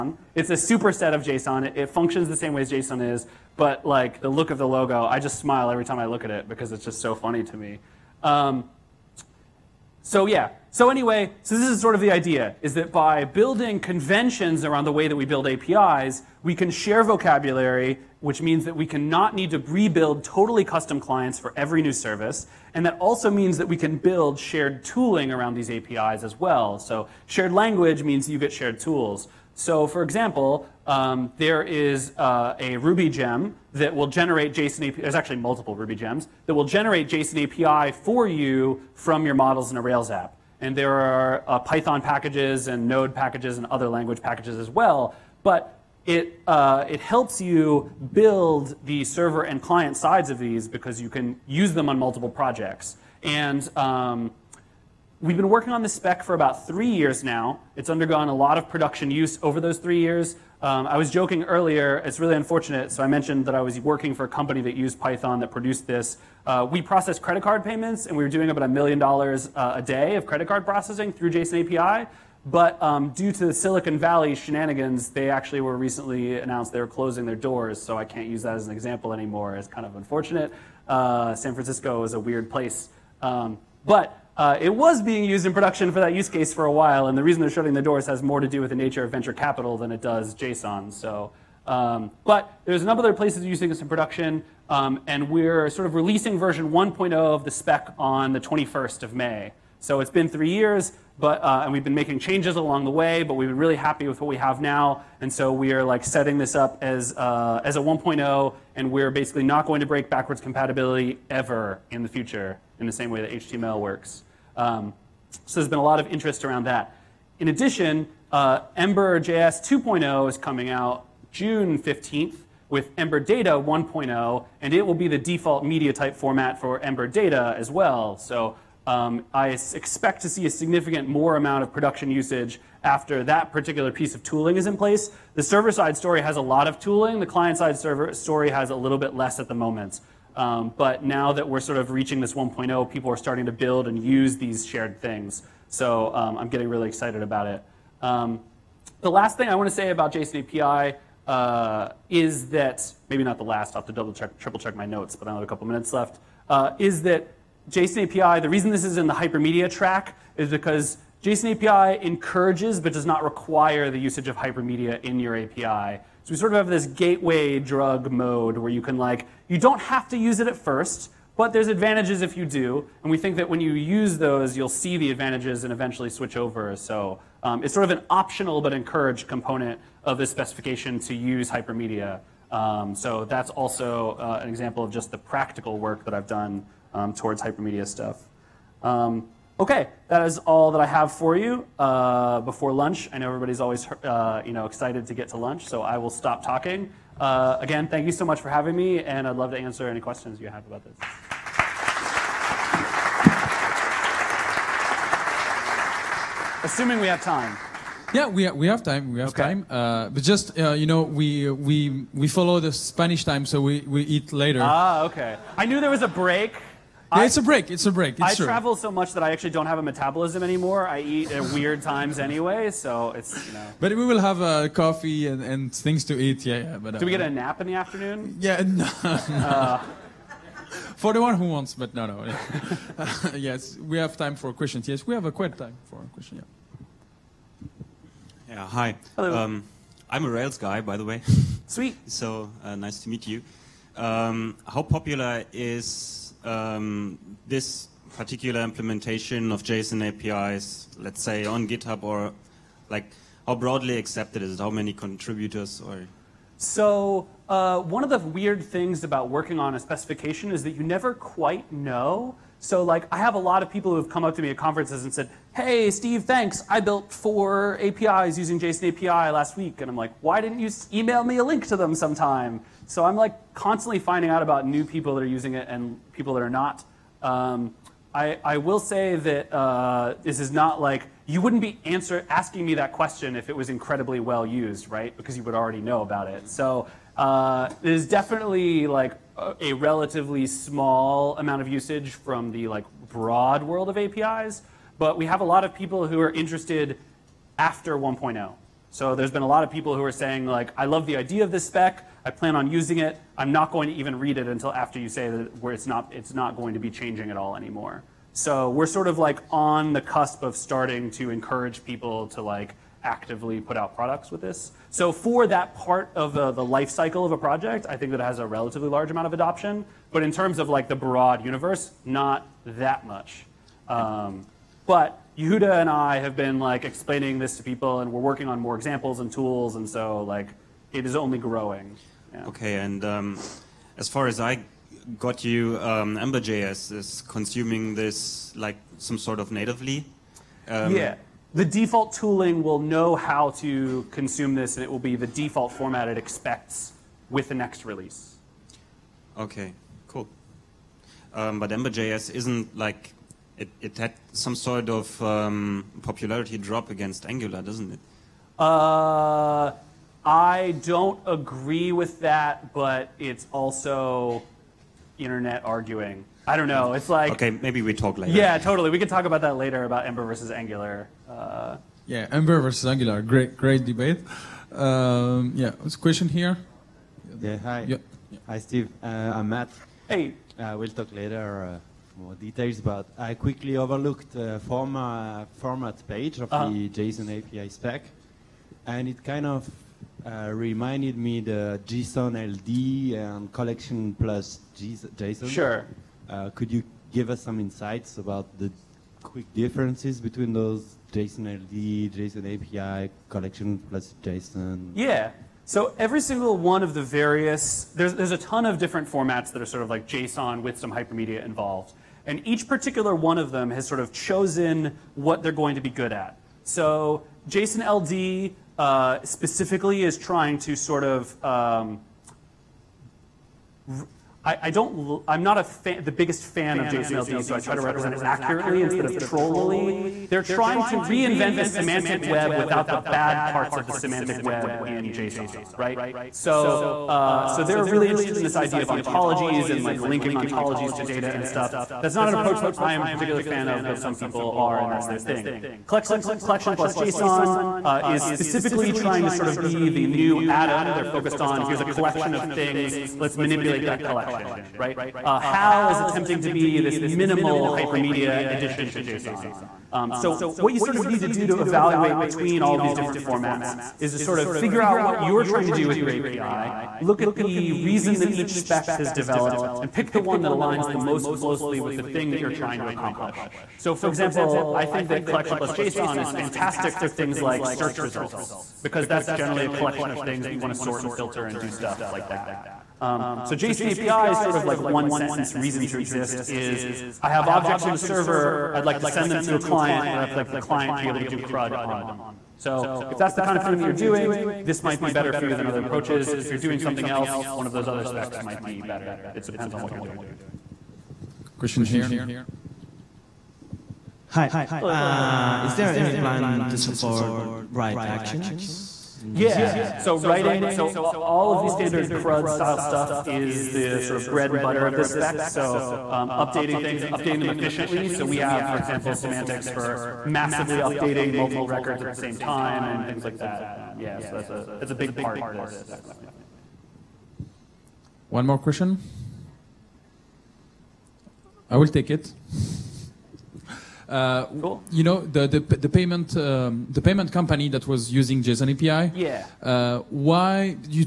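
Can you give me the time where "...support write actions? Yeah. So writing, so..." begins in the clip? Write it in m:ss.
8:26.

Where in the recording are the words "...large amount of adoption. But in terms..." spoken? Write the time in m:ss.
5:18.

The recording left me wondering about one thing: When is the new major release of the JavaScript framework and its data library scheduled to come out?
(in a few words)
June 15th.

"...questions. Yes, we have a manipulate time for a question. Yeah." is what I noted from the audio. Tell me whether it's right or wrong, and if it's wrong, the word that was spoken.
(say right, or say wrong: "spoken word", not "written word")
wrong: "quite", not "manipulate".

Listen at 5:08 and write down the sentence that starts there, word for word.
So we're sort of like on the cusp of starting to encourage people to like actively put out products with this.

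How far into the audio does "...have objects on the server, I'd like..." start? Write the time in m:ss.
8:07.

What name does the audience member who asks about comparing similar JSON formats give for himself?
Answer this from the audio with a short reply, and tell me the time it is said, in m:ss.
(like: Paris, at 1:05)
Matt, at 6:19.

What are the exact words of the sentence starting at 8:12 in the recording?
So if that's the kind of thing that you're doing, this might be better for you than other approaches.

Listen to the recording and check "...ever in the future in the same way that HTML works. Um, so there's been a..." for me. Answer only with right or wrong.
right.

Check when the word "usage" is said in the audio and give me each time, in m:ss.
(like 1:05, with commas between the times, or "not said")
2:12, 2:43, 4:51.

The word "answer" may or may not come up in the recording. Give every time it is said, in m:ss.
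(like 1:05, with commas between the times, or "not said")
3:19, 4:41.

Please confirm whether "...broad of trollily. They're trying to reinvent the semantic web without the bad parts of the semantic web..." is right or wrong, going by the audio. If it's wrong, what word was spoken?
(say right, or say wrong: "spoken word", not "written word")
wrong: "instead", not "broad".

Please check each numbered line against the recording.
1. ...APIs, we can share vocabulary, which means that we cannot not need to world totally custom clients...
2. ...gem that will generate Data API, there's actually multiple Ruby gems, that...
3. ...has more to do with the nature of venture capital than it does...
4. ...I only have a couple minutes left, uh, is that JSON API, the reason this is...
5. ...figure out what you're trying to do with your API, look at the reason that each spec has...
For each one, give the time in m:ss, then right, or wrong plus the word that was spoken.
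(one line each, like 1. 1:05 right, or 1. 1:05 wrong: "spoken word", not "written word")
1. 0:15 wrong: "rebuild", not "world"
2. 0:33 wrong: "JSON", not "Data"
3. 1:28 right
4. 2:35 right
5. 7:44 right.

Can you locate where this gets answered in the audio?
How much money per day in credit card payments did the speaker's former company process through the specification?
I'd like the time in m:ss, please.
1:08.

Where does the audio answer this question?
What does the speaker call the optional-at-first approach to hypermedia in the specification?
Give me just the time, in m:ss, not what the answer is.
2:46.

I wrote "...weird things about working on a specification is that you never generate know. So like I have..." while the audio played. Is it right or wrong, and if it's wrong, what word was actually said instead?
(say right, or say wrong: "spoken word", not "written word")
wrong: "quite", not "generate".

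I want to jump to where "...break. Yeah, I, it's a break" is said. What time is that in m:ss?
3:36.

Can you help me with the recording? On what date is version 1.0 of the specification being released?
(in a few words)
21st of May.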